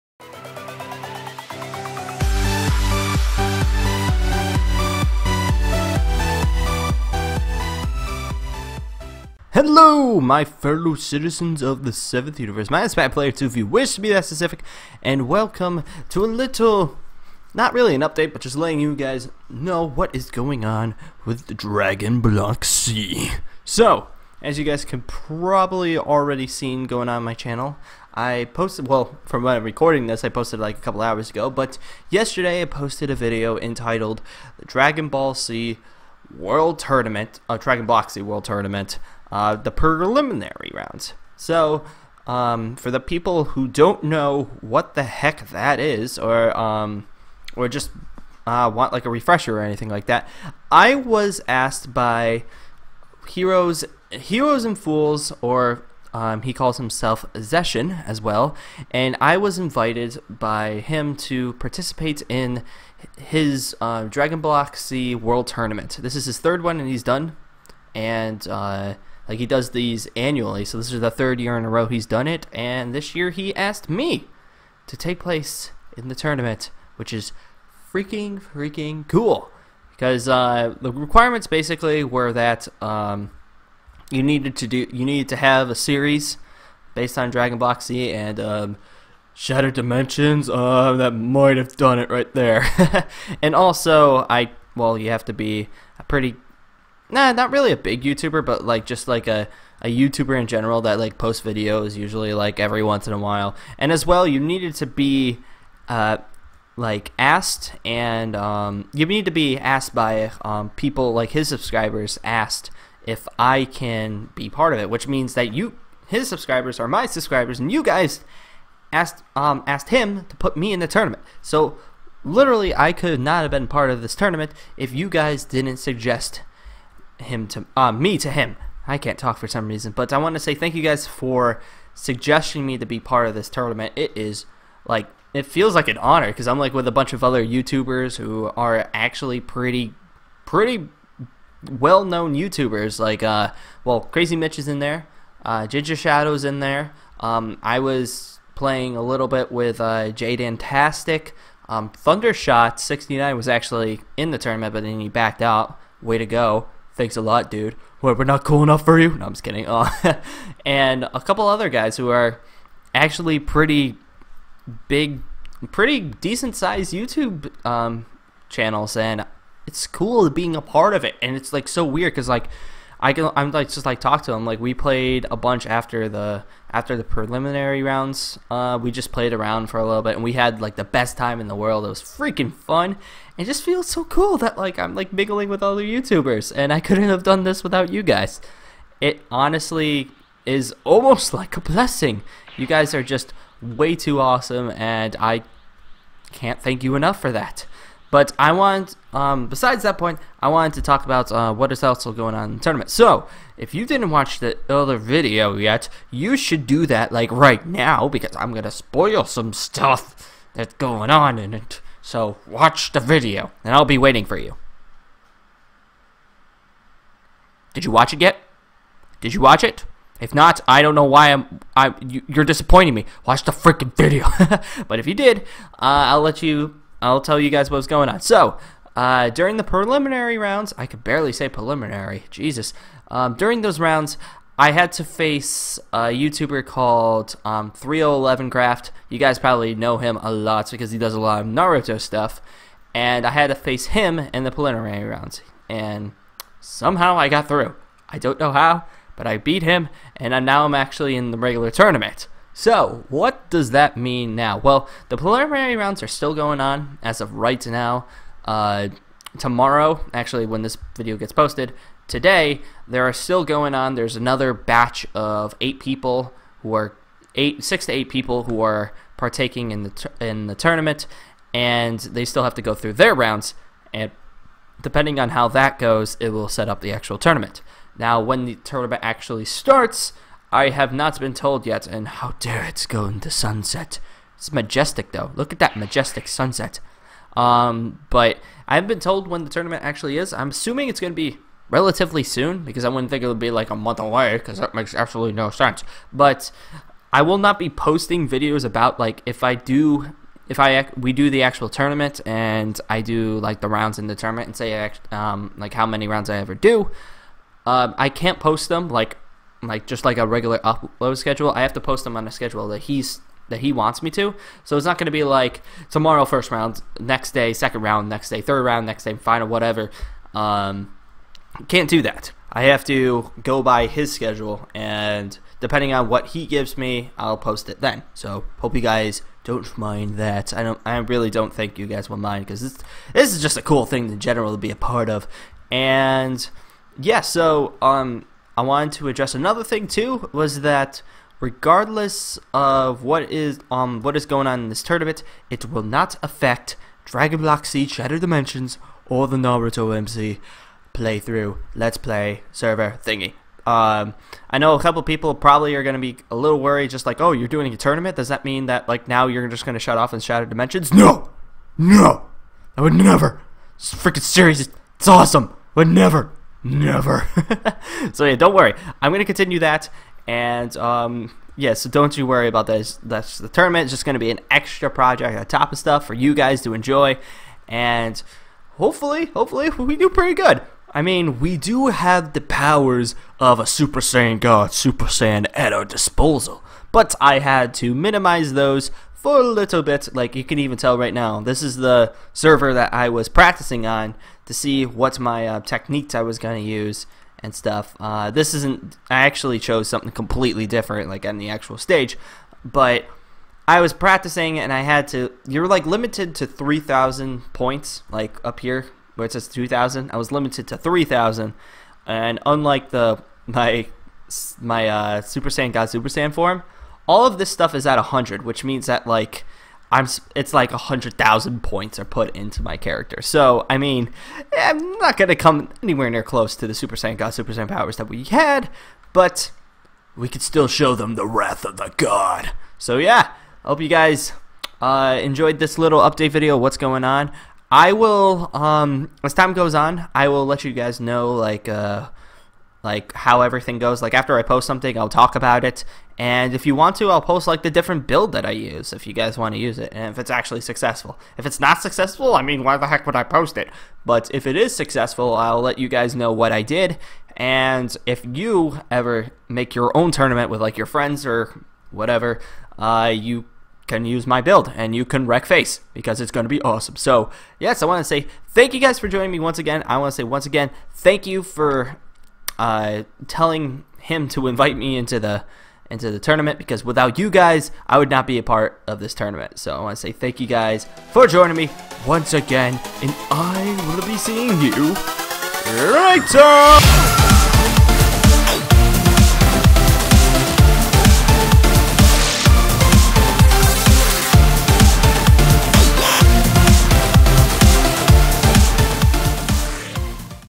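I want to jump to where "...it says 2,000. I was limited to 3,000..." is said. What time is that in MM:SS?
06:49.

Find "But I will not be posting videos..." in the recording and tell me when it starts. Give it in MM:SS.
04:56.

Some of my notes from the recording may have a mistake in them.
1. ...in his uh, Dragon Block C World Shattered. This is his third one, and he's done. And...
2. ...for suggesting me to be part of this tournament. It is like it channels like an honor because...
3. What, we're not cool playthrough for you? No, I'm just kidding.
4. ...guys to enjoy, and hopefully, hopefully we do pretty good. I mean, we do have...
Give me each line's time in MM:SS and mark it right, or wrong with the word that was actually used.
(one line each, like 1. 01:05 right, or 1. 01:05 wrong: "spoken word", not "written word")
1. 01:02 wrong: "Tournament", not "Shattered"
2. 02:11 wrong: "feels", not "channels"
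3. 02:38 wrong: "enough", not "playthrough"
4. 06:16 right.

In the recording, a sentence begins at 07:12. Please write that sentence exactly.
So, yeah, I hope you guys uh, enjoyed this little update video what's going on.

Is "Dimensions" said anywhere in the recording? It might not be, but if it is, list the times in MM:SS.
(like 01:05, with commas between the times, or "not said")
01:29, 05:48, 06:00.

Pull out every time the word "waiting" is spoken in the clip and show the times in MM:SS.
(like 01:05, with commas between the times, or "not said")
03:33.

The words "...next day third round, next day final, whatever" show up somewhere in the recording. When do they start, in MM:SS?
05:18.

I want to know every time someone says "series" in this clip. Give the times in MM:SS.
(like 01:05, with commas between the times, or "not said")
01:25, 06:04.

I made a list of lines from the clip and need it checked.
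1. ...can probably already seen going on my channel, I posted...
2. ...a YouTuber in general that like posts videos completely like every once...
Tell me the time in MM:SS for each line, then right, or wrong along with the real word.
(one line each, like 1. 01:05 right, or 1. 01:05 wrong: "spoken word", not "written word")
1. 00:24 right
2. 01:39 wrong: "usually", not "completely".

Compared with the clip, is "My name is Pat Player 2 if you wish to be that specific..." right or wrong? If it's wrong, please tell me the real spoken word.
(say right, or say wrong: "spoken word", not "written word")
right.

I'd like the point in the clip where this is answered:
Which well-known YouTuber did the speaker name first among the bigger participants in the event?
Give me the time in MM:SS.
02:24.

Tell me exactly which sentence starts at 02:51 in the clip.
And it's like so weird because like I can I'm like just like talk to him.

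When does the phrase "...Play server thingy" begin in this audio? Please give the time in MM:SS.
05:51.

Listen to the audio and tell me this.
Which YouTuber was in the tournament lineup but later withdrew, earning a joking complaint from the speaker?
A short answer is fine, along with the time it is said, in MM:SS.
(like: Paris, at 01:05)
Thundershot69, at 02:31.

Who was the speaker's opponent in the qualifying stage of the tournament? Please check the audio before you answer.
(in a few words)
3011Craft.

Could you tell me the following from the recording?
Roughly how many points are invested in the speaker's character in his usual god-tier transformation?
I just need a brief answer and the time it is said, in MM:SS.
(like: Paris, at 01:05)
100,000, at 07:00.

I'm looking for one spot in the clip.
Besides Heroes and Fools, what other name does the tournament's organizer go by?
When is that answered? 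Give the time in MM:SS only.
00:57.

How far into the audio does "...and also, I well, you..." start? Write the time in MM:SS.
01:33.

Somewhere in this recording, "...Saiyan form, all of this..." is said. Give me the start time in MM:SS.
06:56.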